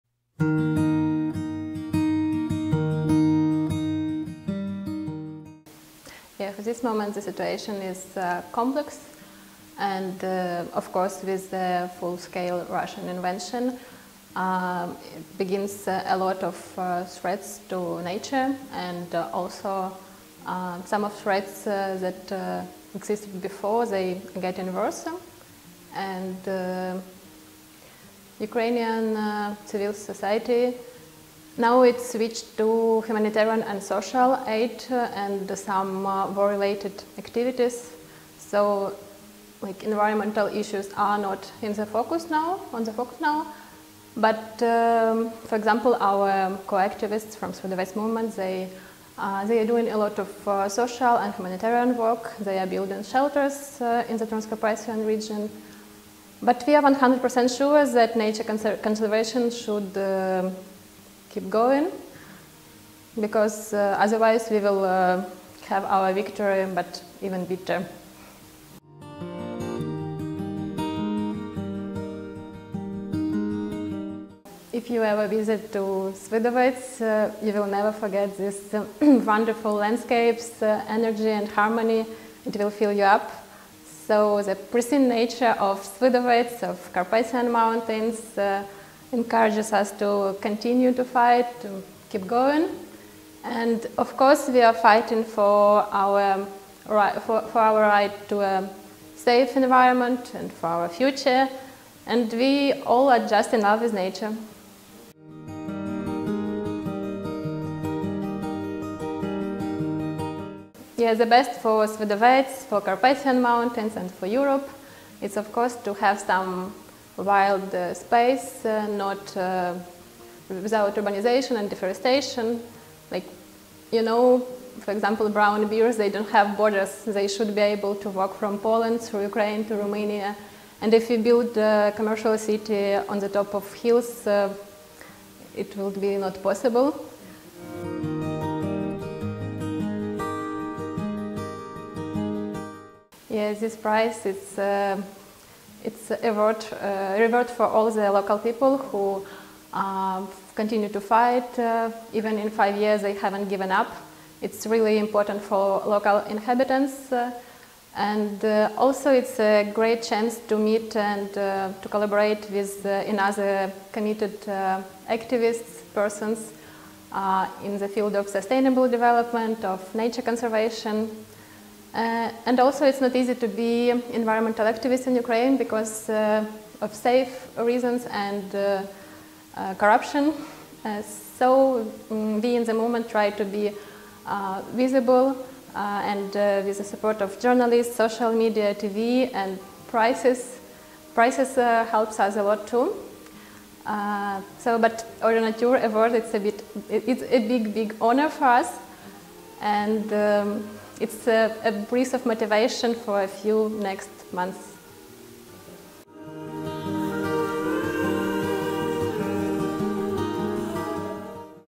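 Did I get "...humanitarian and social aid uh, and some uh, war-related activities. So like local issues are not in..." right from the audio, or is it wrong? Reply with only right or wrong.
wrong.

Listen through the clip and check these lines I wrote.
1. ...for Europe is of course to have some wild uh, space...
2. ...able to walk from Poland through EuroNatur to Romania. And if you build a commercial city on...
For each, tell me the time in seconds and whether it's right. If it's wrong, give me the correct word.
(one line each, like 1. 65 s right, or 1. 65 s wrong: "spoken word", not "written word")
1. 114 s right
2. 127 s wrong: "Ukraine", not "EuroNatur".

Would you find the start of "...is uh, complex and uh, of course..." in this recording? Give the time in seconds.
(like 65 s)
7 s.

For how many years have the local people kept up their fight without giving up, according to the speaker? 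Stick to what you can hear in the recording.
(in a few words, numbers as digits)
5.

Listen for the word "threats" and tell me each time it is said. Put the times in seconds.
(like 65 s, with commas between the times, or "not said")
17 s, 21 s.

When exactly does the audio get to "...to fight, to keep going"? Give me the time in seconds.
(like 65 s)
90 s.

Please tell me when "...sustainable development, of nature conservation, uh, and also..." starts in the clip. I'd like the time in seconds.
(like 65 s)
168 s.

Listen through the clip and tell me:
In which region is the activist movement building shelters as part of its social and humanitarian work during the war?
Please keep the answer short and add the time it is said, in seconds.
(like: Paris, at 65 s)
Transcarpathian region, at 54 s.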